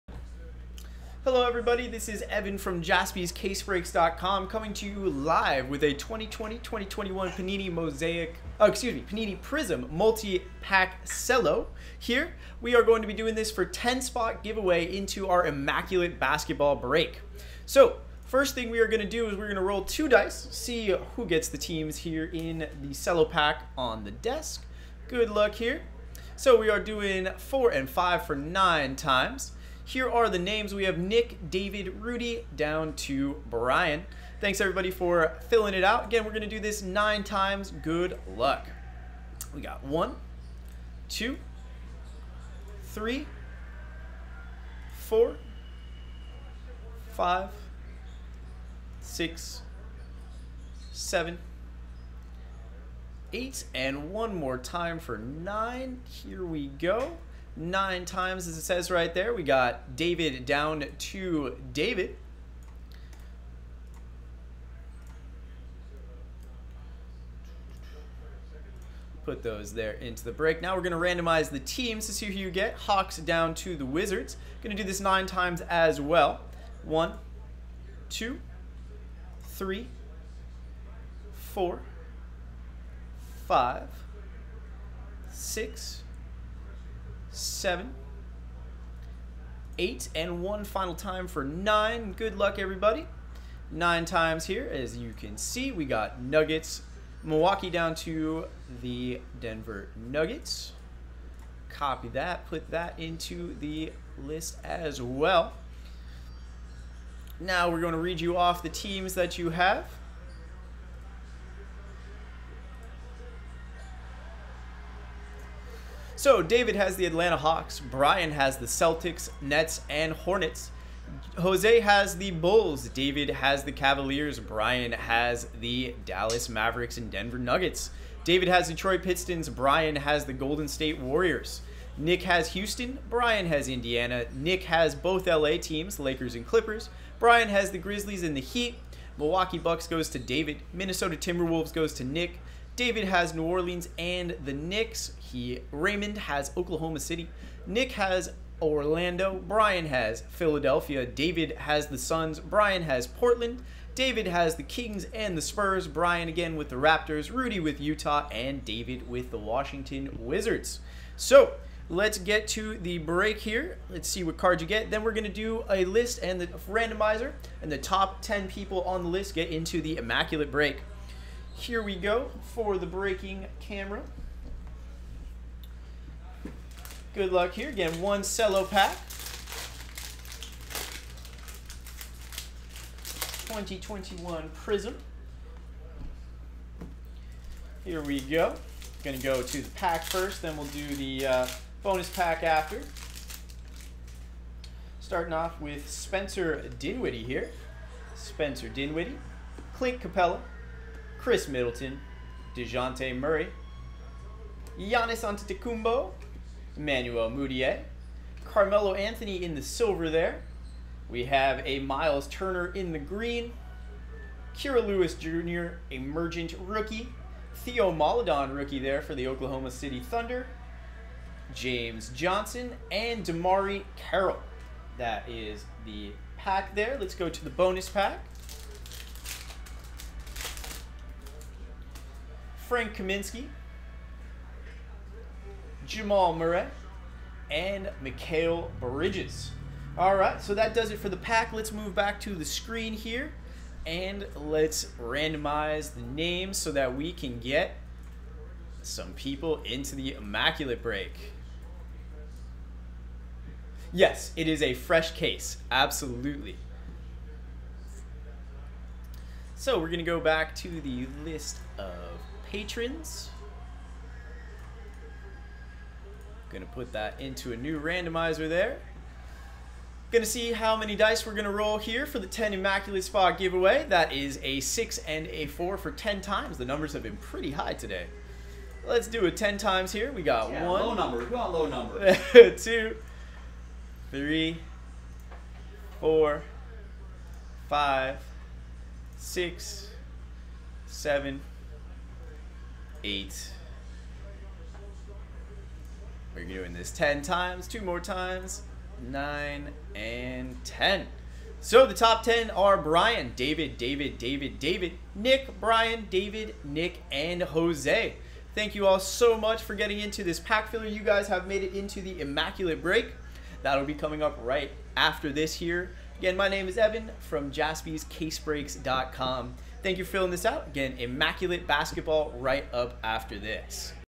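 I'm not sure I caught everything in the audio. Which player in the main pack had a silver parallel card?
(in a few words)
Carmelo Anthony.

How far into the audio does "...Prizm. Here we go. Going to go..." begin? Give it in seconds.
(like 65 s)
184 s.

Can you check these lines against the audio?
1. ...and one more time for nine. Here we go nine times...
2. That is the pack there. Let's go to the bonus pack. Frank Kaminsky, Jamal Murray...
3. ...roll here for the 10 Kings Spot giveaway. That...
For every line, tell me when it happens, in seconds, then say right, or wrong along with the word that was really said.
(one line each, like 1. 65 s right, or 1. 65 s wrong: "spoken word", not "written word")
1. 53 s right
2. 224 s right
3. 271 s wrong: "Immaculate", not "Kings".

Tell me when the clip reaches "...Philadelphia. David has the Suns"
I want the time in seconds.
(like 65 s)
150 s.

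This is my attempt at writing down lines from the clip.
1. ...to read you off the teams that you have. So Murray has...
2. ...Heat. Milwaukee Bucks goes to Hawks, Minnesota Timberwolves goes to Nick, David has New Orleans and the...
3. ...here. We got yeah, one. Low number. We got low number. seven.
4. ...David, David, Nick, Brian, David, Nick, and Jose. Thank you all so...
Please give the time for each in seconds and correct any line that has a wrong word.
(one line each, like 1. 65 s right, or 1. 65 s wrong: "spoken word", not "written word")
1. 107 s wrong: "David", not "Murray"
2. 138 s wrong: "David", not "Hawks"
3. 279 s wrong: "two", not "seven"
4. 304 s right.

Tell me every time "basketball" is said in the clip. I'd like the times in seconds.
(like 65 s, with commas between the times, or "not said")
16 s, 321 s.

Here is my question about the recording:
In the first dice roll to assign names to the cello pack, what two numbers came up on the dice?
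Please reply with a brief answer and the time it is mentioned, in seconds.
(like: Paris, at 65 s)
4 and 5, at 27 s.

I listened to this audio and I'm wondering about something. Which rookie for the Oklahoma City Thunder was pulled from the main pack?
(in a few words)
Theo Maledon.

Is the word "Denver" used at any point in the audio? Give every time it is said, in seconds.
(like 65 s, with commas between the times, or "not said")
99 s, 127 s.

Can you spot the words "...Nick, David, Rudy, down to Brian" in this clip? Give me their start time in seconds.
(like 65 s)
30 s.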